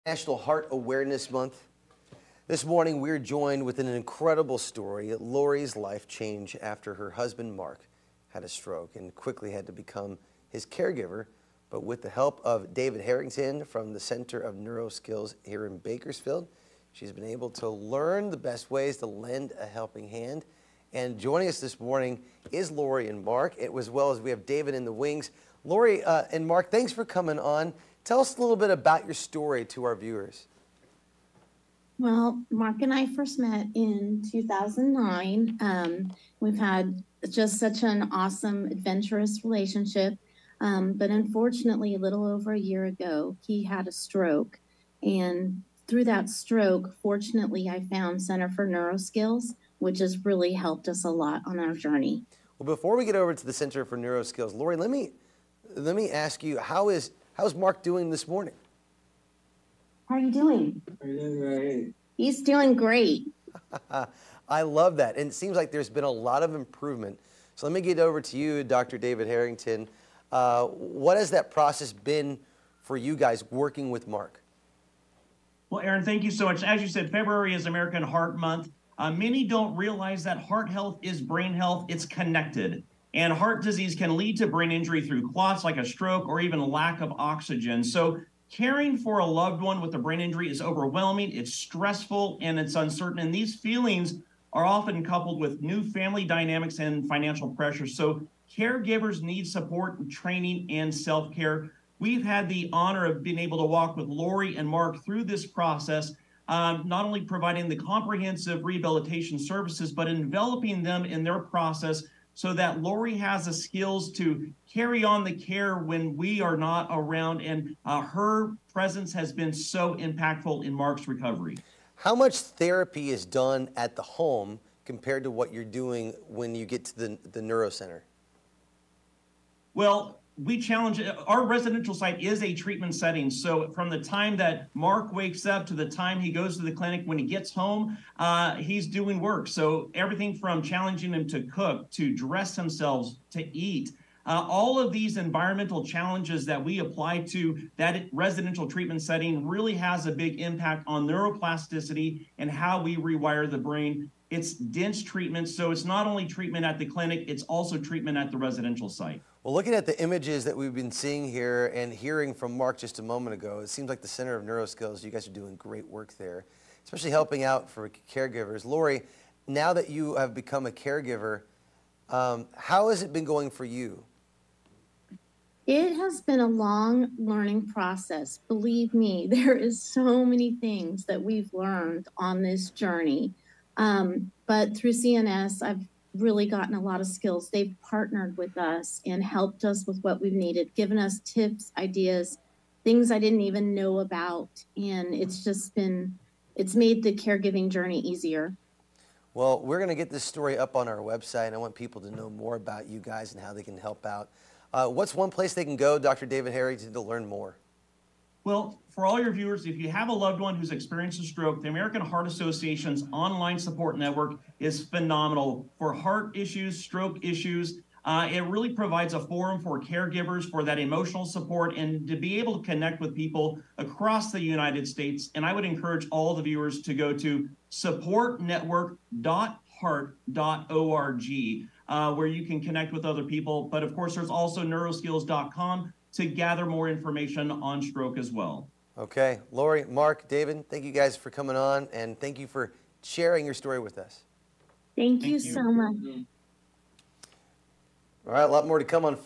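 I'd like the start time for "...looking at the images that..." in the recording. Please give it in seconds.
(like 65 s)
159 s.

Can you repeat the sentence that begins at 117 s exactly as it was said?
And uh, her presence has been so impactful in Mark's recovery.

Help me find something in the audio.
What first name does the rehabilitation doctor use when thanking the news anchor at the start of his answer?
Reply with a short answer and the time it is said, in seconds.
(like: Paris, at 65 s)
Aaron, at 75 s.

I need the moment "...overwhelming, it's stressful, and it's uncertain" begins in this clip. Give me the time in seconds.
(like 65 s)
90 s.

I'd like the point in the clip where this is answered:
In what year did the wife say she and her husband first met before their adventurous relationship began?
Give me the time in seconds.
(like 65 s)
34 s.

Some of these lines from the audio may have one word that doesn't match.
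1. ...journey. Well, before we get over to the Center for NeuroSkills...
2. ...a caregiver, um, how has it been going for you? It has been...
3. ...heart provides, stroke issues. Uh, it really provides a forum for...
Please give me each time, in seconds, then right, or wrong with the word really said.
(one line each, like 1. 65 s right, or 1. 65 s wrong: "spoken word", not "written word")
1. 51 s right
2. 170 s right
3. 215 s wrong: "issues", not "provides".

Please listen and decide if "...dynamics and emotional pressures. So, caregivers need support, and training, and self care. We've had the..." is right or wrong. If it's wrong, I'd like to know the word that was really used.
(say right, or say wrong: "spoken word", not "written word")
wrong: "financial", not "emotional".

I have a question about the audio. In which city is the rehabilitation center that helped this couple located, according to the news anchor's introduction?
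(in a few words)
Bakersfield.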